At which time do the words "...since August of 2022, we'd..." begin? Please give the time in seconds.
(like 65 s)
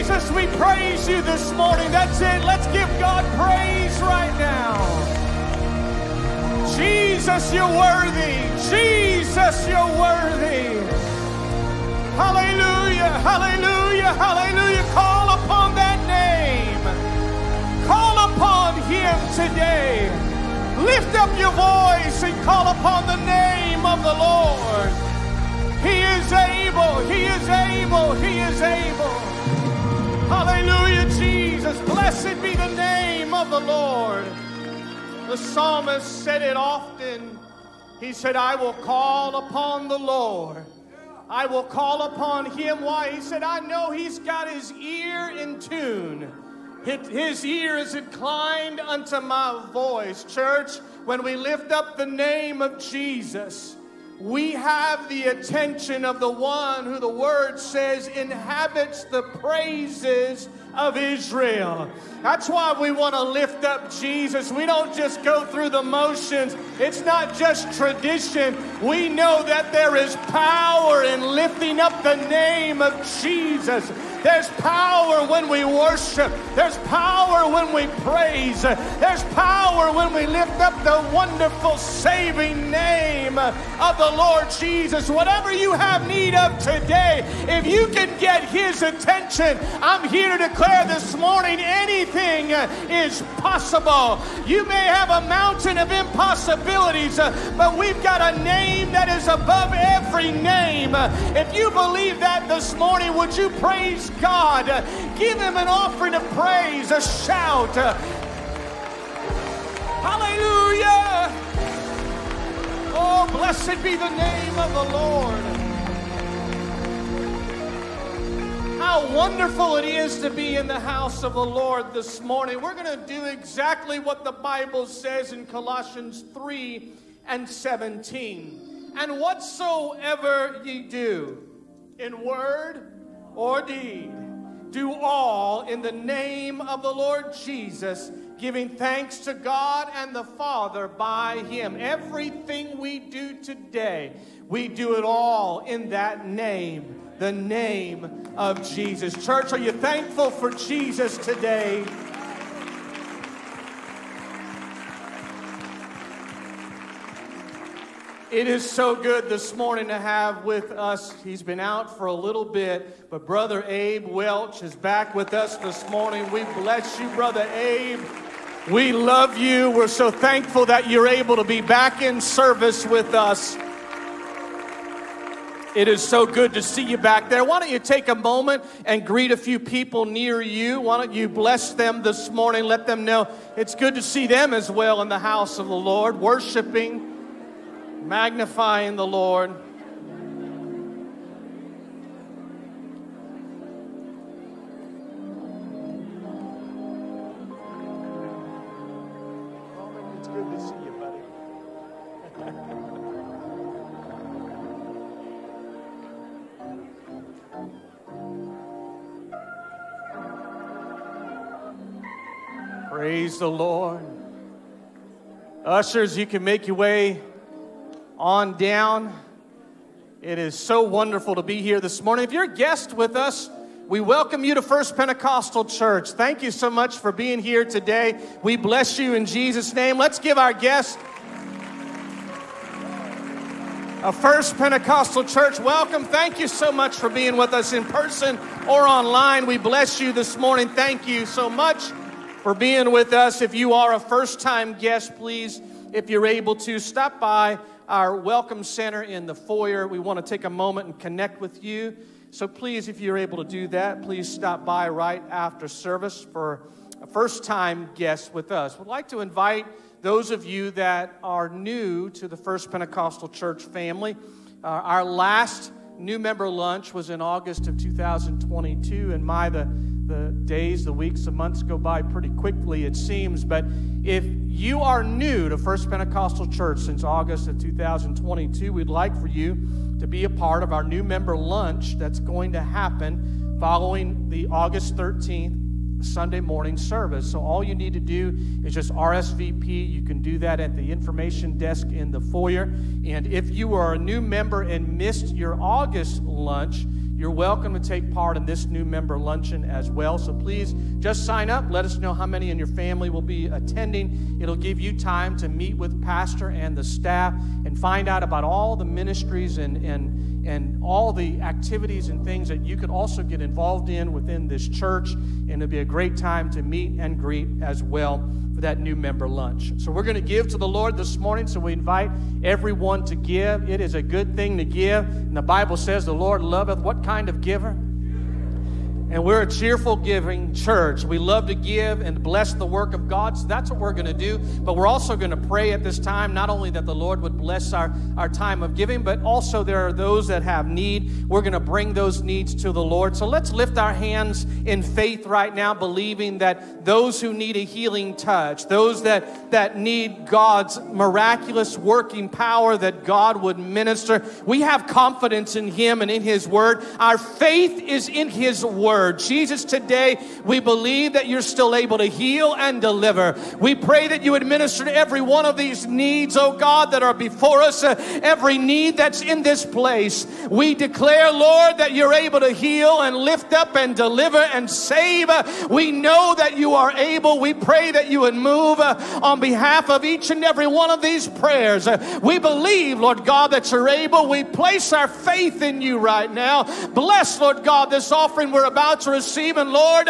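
276 s.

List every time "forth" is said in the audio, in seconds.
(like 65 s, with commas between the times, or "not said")
not said.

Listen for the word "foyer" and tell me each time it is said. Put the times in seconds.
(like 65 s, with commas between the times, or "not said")
249 s, 292 s.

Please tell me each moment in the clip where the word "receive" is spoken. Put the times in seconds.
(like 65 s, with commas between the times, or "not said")
389 s.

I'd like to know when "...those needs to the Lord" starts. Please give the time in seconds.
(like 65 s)
341 s.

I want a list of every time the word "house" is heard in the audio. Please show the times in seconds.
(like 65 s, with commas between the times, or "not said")
120 s, 185 s.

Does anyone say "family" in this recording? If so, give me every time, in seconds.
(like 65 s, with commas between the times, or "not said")
263 s, 302 s.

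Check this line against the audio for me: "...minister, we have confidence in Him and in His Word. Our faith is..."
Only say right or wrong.
right.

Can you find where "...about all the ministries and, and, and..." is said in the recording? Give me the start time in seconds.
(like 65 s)
308 s.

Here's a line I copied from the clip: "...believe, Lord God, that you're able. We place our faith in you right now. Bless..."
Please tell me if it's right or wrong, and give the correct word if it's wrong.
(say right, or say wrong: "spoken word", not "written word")
right.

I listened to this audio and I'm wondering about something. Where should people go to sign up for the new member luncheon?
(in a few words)
information desk.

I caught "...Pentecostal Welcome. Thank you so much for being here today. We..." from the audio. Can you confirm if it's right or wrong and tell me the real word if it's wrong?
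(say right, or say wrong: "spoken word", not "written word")
wrong: "Church", not "Welcome".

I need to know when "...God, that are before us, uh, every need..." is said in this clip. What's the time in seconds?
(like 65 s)
366 s.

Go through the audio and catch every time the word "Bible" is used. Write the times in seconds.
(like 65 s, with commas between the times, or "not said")
124 s, 325 s.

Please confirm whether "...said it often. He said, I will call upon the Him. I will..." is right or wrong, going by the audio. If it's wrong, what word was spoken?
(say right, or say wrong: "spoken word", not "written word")
wrong: "Lord", not "Him".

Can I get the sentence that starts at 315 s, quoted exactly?
And it'll be a great time to meet and greet as well for that new member lunch.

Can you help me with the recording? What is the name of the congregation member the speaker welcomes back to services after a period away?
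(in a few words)
Abe Welch.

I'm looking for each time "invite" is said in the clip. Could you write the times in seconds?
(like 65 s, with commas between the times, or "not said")
259 s, 321 s.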